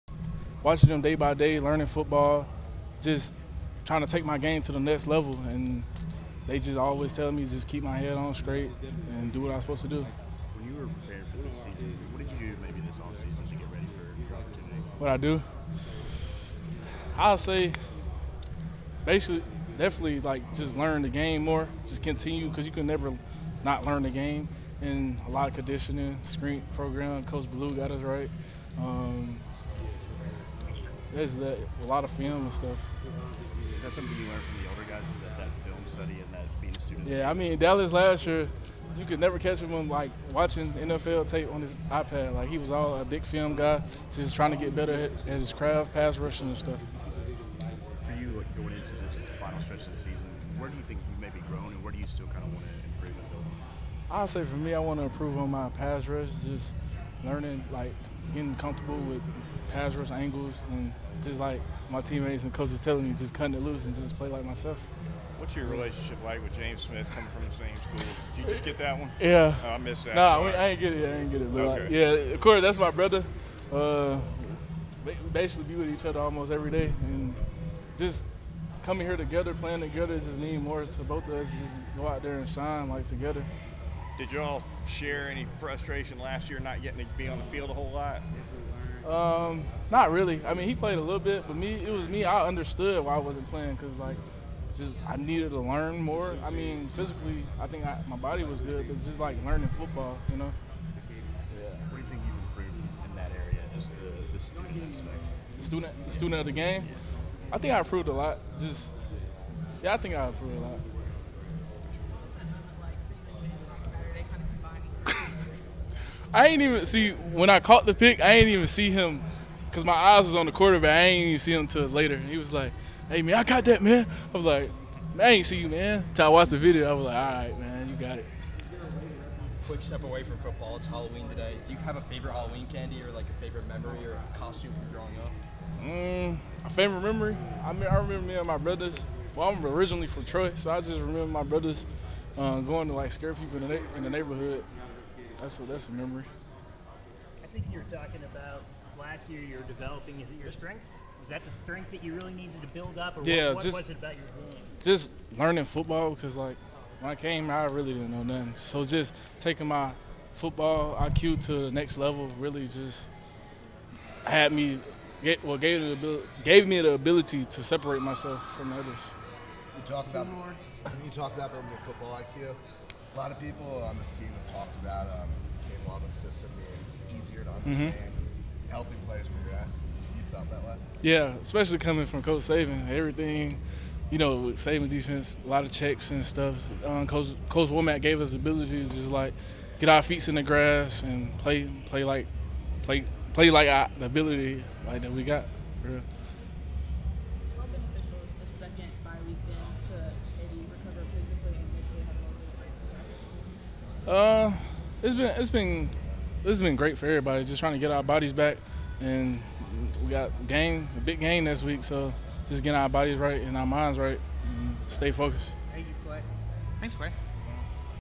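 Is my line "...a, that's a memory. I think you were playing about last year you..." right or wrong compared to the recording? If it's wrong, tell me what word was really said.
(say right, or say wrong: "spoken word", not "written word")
wrong: "talking", not "playing".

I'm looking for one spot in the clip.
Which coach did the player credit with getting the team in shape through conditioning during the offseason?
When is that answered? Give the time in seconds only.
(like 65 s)
27 s.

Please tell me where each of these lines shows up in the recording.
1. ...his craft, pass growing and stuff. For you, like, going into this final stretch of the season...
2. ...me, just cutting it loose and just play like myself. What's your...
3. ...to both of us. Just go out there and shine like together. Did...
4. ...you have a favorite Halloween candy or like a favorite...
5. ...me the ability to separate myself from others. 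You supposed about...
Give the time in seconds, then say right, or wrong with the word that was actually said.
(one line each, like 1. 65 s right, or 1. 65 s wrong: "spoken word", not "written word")
1. 45 s wrong: "rushing", not "growing"
2. 63 s right
3. 80 s right
4. 131 s right
5. 166 s wrong: "talked", not "supposed".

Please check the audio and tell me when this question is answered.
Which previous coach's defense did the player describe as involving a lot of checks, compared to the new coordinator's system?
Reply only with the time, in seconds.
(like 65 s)
182 s.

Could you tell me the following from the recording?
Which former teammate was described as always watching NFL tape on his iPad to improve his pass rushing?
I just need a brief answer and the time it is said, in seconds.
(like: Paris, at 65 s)
Dallas, at 37 s.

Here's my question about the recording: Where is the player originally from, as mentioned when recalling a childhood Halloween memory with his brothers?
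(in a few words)
Troy.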